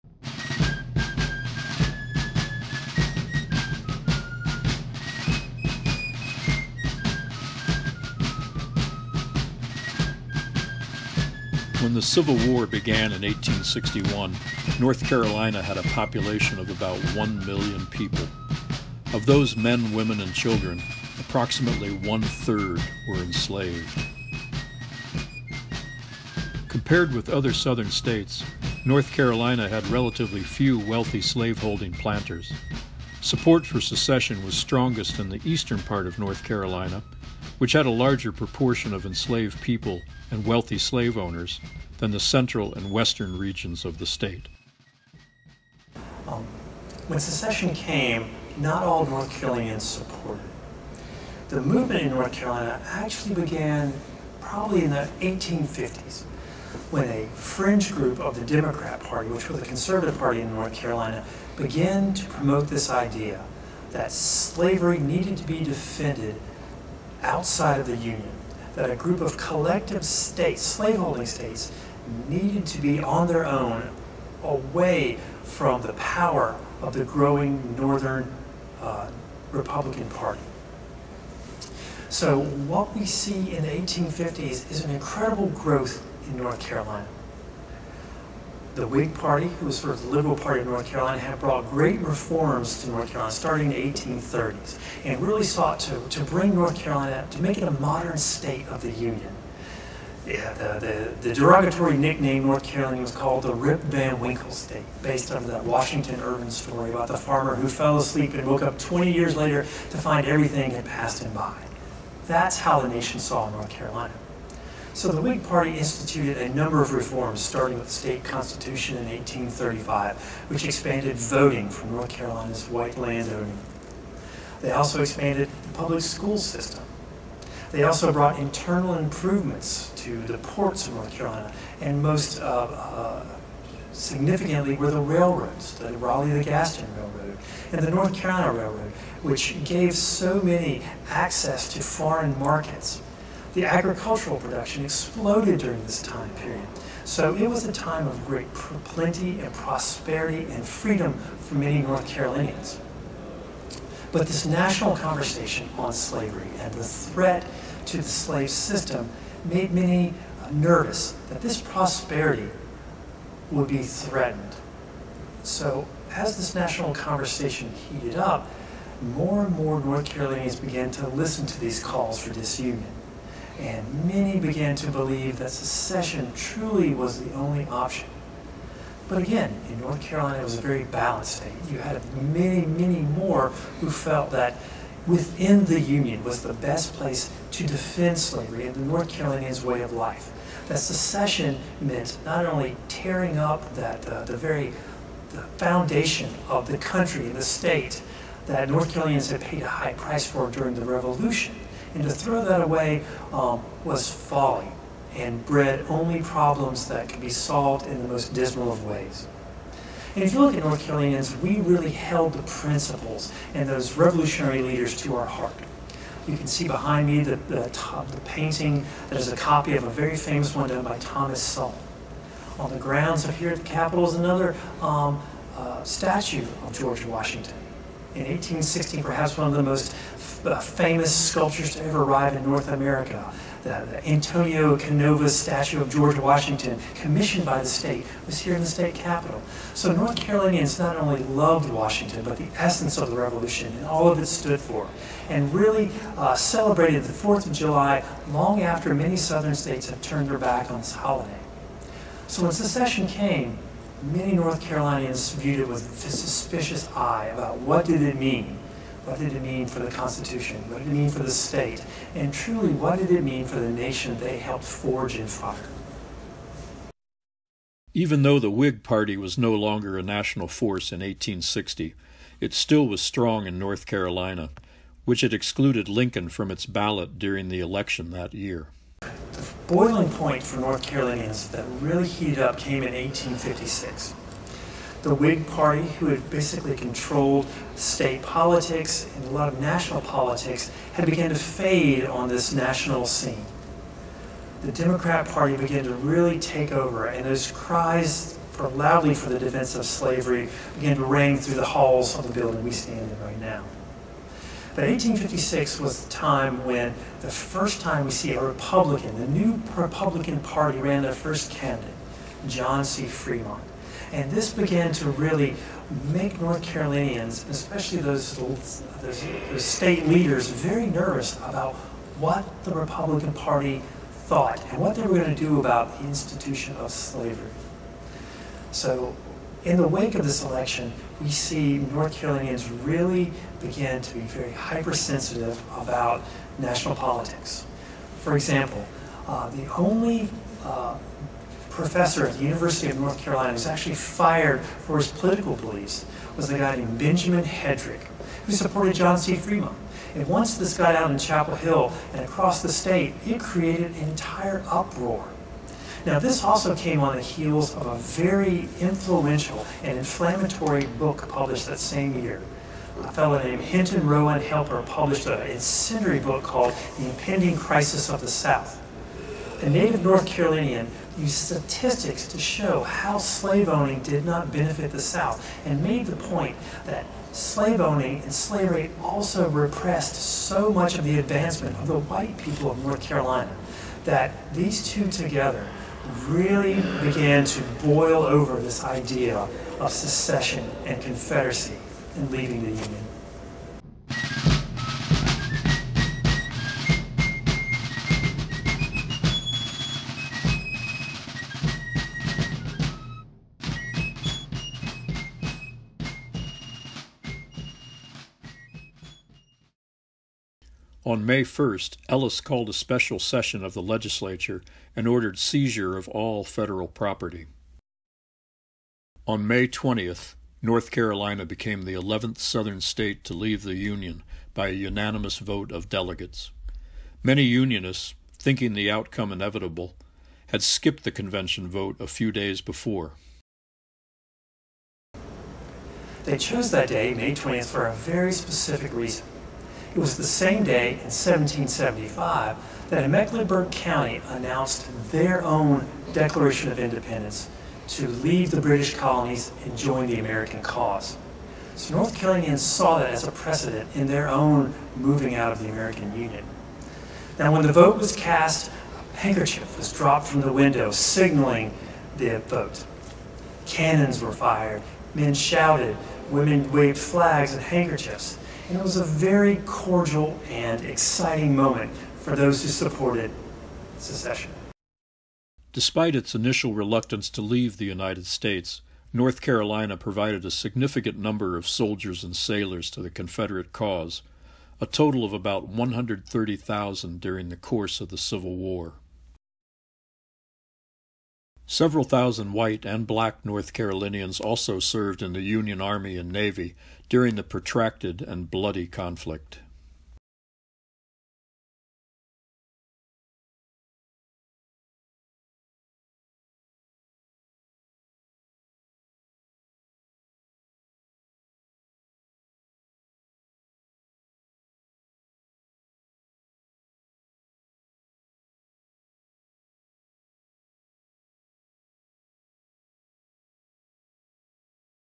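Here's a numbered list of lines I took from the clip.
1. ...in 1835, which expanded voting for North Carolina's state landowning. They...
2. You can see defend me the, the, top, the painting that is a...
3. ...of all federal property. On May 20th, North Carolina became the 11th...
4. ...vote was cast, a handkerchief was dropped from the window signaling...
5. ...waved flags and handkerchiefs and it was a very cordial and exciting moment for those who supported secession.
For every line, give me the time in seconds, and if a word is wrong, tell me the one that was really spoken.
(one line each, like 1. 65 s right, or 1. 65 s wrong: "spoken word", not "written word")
1. 118 s wrong: "white", not "state"
2. 216 s wrong: "behind", not "defend"
3. 415 s right
4. 457 s right
5. 466 s right.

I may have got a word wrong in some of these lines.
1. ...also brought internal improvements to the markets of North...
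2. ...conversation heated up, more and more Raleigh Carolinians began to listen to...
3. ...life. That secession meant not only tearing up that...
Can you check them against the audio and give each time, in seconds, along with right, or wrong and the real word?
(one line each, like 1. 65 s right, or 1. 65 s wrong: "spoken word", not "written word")
1. 127 s wrong: "ports", not "markets"
2. 166 s wrong: "North", not "Raleigh"
3. 189 s right.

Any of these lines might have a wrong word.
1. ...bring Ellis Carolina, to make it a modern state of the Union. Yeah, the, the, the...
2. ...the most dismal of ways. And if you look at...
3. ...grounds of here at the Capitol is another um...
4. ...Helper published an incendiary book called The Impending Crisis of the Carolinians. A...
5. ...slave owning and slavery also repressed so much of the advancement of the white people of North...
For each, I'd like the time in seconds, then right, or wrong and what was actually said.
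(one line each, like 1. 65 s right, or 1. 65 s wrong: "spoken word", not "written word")
1. 96 s wrong: "North", not "Ellis"
2. 208 s right
3. 222 s right
4. 364 s wrong: "South", not "Carolinians"
5. 377 s right.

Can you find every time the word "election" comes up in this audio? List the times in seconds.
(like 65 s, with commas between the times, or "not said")
277 s, 330 s.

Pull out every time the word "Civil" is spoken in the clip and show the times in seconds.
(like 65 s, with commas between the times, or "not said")
12 s, 488 s.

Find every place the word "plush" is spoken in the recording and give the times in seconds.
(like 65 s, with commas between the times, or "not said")
not said.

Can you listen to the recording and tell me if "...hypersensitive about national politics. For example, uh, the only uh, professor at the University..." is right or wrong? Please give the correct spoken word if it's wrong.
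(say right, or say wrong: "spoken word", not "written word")
right.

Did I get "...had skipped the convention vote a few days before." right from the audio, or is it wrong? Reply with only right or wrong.
right.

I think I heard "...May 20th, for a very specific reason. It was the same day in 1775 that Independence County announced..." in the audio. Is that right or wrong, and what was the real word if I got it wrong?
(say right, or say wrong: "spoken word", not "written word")
wrong: "Mecklenburg", not "Independence".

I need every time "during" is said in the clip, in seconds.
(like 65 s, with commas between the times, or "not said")
145 s, 200 s, 277 s, 487 s, 497 s.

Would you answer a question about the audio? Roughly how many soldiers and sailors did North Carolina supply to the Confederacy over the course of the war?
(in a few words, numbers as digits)
130,000.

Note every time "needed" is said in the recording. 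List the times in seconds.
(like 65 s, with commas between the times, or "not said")
64 s, 72 s.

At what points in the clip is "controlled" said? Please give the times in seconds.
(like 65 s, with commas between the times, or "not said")
286 s.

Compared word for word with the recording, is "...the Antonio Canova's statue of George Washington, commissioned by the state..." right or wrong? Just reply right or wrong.
right.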